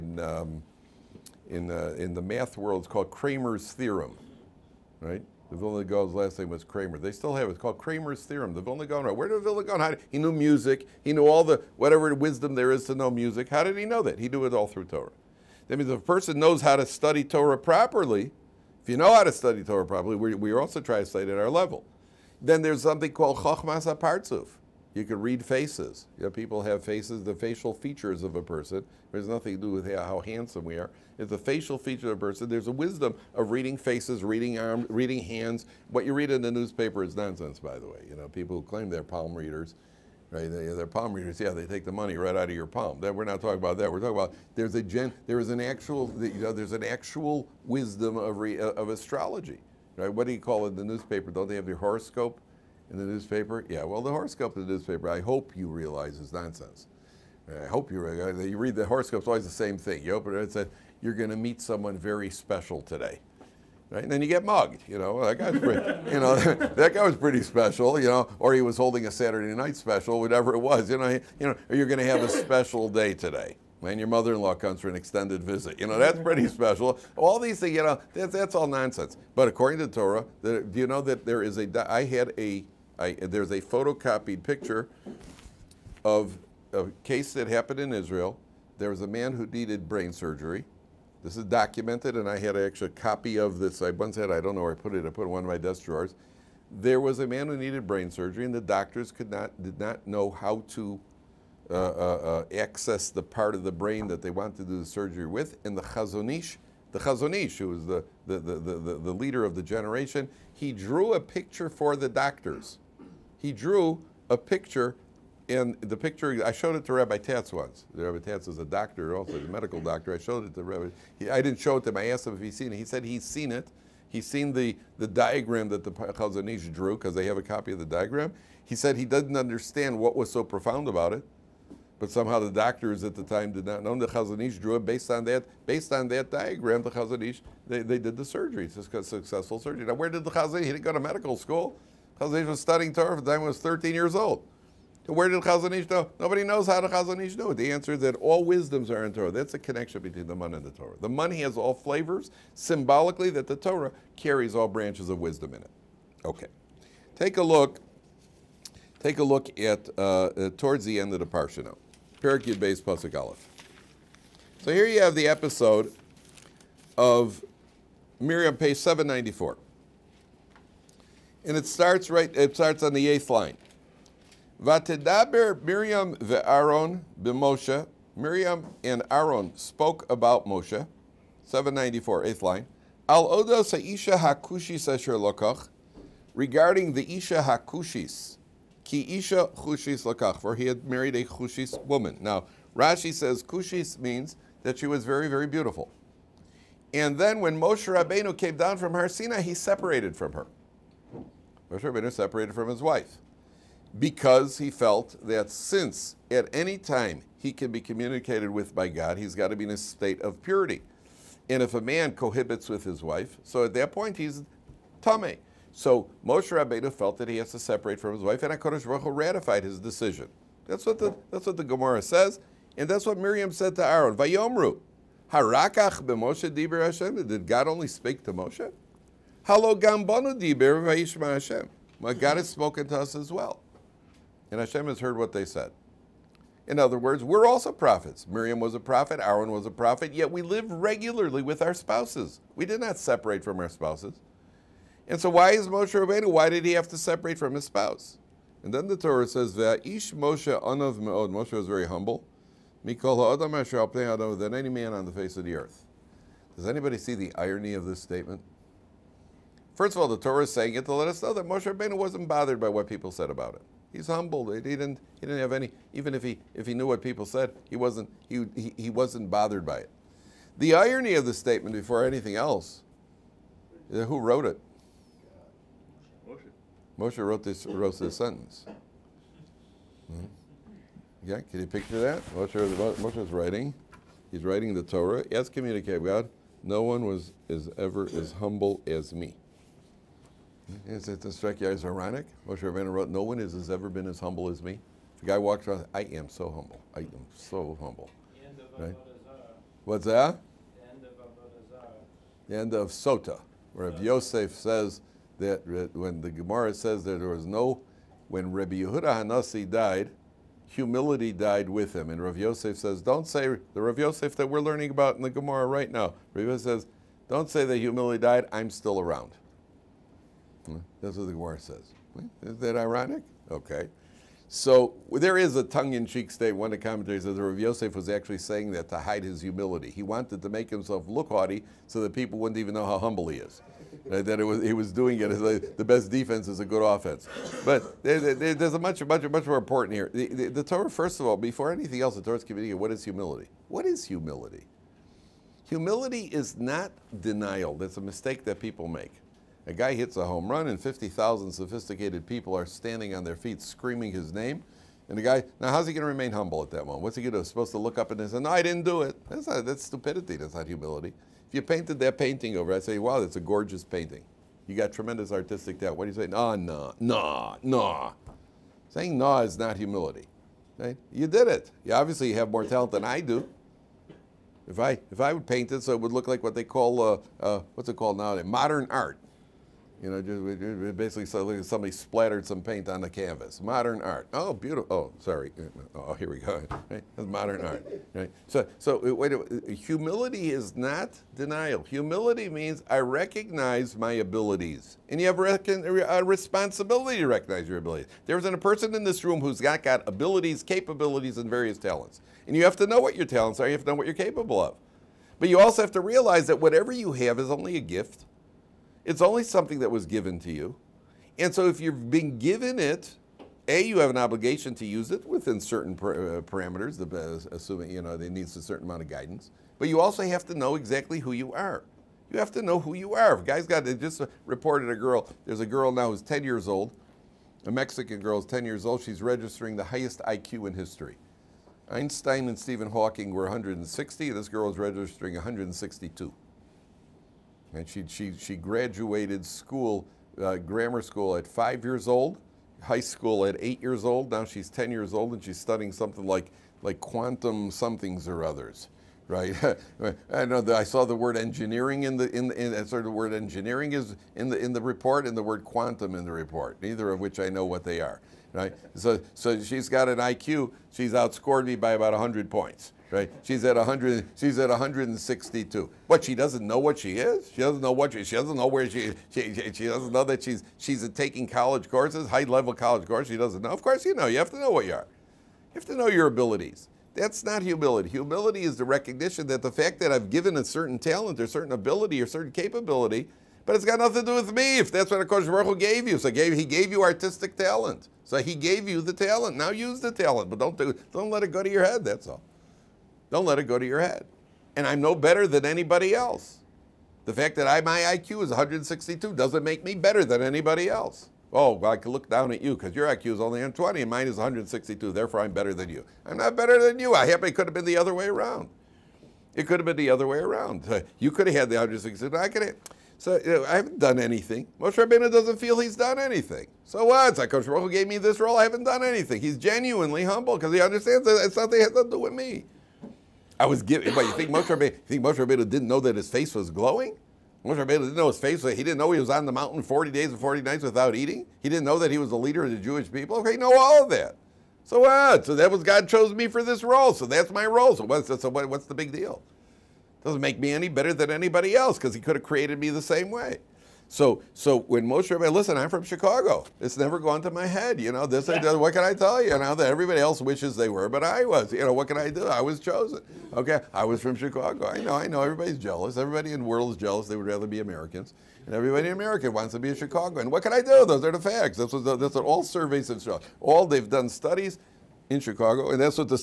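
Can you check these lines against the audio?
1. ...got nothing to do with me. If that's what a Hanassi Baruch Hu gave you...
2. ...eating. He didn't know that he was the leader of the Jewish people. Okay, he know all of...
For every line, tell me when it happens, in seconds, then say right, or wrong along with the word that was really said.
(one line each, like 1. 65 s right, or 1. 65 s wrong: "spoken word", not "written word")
1. 483 s wrong: "Kosh", not "Hanassi"
2. 531 s right.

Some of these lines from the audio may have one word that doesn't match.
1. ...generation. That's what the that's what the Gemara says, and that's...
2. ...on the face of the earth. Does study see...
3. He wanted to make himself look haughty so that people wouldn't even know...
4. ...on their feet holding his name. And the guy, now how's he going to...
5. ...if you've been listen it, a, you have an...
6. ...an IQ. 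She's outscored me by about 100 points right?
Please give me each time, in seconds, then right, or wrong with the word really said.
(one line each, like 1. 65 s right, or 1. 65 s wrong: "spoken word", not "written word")
1. 219 s wrong: "decision", not "generation"
2. 254 s wrong: "anybody", not "study"
3. 329 s right
4. 353 s wrong: "screaming", not "holding"
5. 411 s wrong: "given", not "listen"
6. 460 s right.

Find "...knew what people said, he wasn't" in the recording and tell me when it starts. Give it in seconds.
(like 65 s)
266 s.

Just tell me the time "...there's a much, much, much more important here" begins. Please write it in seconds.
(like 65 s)
338 s.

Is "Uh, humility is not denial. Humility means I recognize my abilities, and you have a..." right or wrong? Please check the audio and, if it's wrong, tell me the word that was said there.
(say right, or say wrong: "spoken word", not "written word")
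right.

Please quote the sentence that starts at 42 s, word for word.
That we're not talking about that.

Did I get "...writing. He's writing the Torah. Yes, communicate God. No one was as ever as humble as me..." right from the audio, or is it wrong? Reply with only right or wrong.
right.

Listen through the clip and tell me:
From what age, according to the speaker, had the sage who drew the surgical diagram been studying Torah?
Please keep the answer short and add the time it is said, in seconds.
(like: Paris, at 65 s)
13, at 143 s.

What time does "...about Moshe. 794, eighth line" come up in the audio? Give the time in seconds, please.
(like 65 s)
180 s.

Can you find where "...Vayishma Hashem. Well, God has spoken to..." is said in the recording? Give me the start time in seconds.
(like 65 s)
230 s.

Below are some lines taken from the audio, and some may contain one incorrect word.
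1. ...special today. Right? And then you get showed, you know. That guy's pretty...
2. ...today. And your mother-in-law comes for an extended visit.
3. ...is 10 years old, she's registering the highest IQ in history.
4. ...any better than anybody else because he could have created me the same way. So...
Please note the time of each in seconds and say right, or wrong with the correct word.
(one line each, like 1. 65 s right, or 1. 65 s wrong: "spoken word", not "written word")
1. 62 s wrong: "mugged", not "showed"
2. 73 s right
3. 428 s right
4. 540 s right.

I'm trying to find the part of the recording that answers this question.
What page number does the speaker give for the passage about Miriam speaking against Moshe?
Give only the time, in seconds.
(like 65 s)
168 s.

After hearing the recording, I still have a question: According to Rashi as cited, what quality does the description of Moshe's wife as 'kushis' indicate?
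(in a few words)
very beautiful.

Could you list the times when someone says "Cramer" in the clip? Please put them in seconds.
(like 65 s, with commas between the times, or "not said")
3 s.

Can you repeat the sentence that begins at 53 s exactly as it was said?
Yeah, well, the horoscope in the newspaper, I hope you realize is nonsense.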